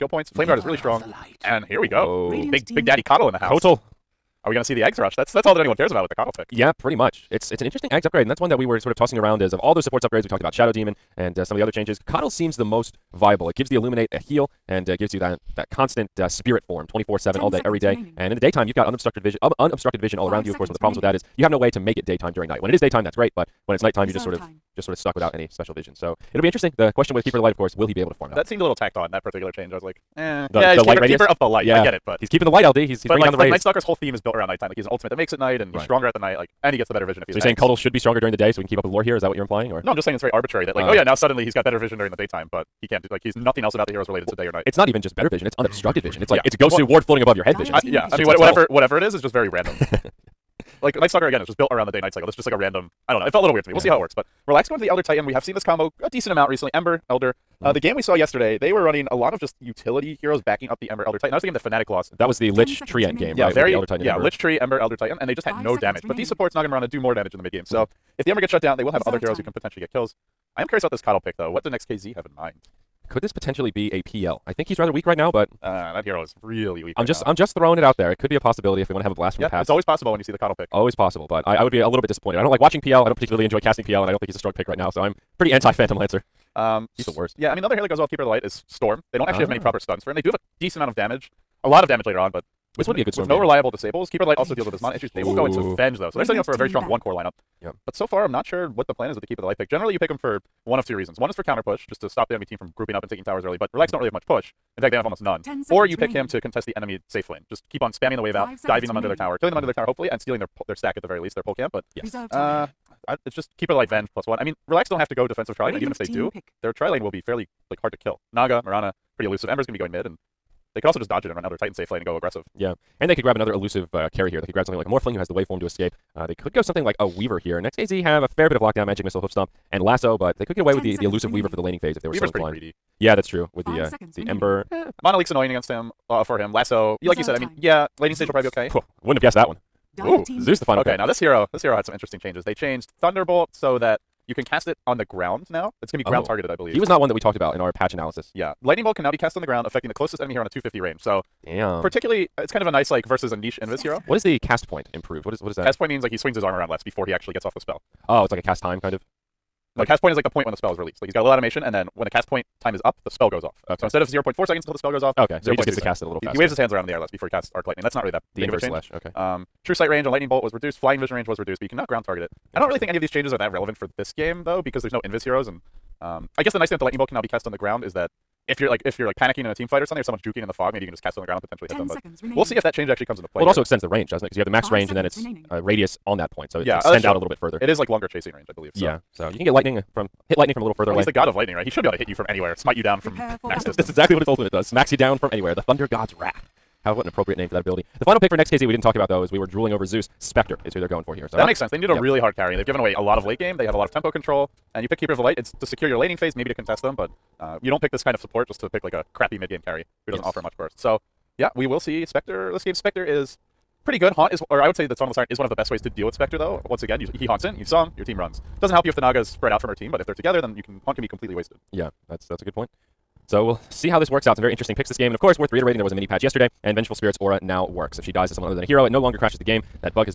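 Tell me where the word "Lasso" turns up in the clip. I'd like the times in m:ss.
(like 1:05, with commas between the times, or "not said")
2:09, 2:16.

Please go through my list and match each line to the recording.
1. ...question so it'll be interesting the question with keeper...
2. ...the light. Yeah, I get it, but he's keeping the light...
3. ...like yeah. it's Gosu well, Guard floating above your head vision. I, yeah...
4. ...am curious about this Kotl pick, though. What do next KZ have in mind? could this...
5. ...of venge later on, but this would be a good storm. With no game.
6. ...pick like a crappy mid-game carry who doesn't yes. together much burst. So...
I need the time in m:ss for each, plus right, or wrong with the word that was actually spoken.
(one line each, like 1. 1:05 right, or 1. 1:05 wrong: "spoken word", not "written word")
1. 0:25 wrong: "vision", not "question"
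2. 0:31 right
3. 0:46 wrong: "Ward", not "Guard"
4. 1:10 right
5. 1:31 wrong: "damage", not "venge"
6. 3:28 wrong: "offer", not "together".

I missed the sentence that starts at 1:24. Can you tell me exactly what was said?
So I'm pretty anti Phantom Lancer.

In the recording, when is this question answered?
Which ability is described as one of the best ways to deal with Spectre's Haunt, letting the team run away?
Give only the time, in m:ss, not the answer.
3:34.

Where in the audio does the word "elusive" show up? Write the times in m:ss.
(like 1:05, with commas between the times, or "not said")
1:59, 2:03, 2:11.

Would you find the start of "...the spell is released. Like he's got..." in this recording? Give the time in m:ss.
2:40.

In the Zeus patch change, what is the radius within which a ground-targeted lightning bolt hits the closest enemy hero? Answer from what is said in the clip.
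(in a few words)
250.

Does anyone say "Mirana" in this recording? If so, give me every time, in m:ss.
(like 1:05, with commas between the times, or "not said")
1:06, 1:58.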